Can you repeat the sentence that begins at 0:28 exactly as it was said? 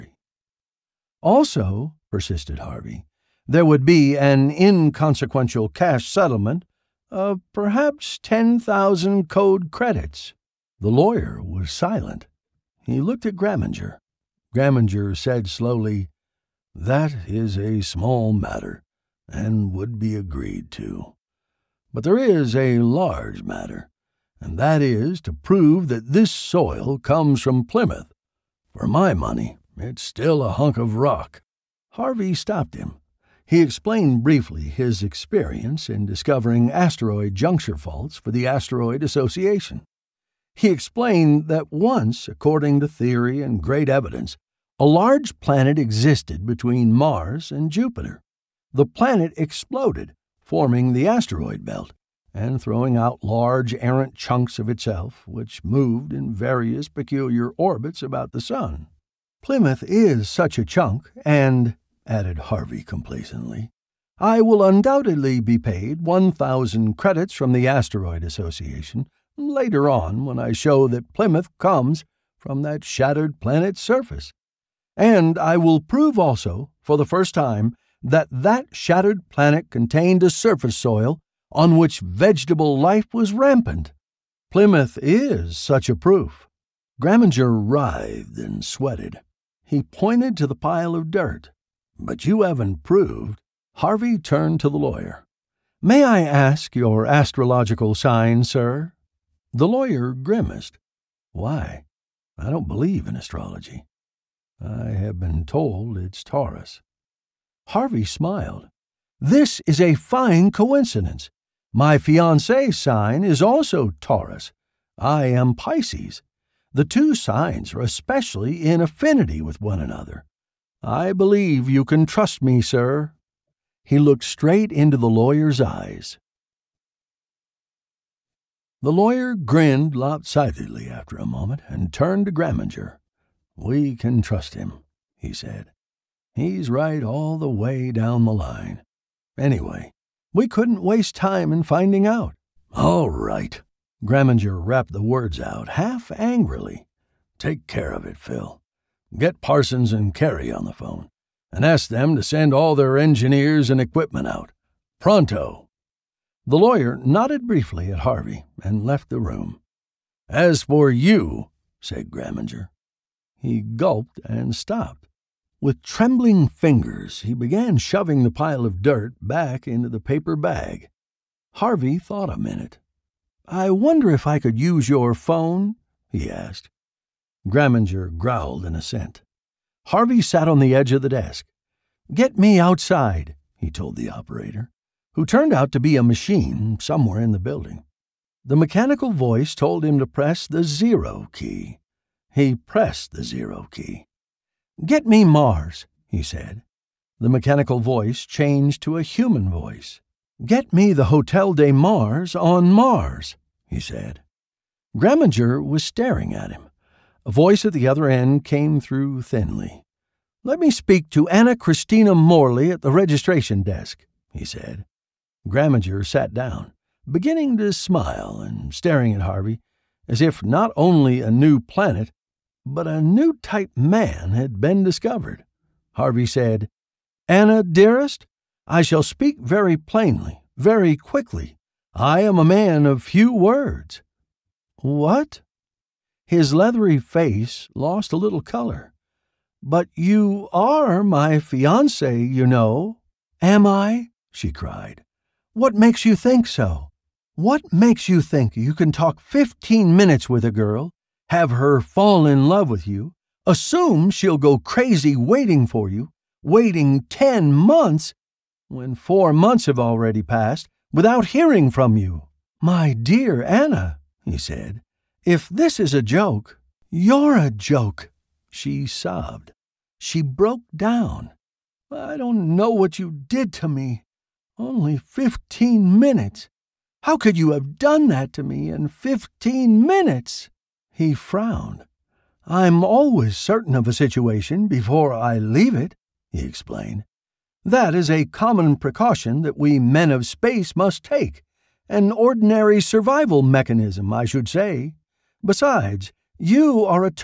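For my money, it's still a hunk of rock.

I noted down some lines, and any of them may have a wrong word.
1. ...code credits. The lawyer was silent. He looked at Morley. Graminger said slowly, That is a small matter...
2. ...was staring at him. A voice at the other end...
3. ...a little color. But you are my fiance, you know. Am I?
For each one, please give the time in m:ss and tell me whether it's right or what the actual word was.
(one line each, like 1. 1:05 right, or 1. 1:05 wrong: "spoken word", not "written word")
1. 0:09 wrong: "Graminger", not "Morley"
2. 3:25 right
3. 3:58 right.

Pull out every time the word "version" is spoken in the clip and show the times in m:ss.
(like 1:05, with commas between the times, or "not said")
not said.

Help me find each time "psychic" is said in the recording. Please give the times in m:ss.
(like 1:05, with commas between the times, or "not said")
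not said.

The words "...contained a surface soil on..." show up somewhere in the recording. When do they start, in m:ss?
1:19.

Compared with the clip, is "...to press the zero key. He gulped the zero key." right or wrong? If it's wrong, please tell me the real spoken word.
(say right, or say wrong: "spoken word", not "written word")
wrong: "pressed", not "gulped".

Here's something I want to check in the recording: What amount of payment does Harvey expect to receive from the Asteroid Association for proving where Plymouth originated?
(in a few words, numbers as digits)
1,000 credits.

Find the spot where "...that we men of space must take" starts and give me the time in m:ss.
4:49.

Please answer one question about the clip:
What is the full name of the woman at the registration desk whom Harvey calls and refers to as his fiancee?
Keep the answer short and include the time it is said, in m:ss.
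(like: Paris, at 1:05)
Anna Christina Morley, at 3:31.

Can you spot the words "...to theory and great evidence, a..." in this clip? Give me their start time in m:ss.
0:42.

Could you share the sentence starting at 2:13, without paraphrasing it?
We can trust him, he said.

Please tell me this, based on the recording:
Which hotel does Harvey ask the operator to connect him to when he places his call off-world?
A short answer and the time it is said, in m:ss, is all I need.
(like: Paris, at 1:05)
Hotel de Mars, at 3:21.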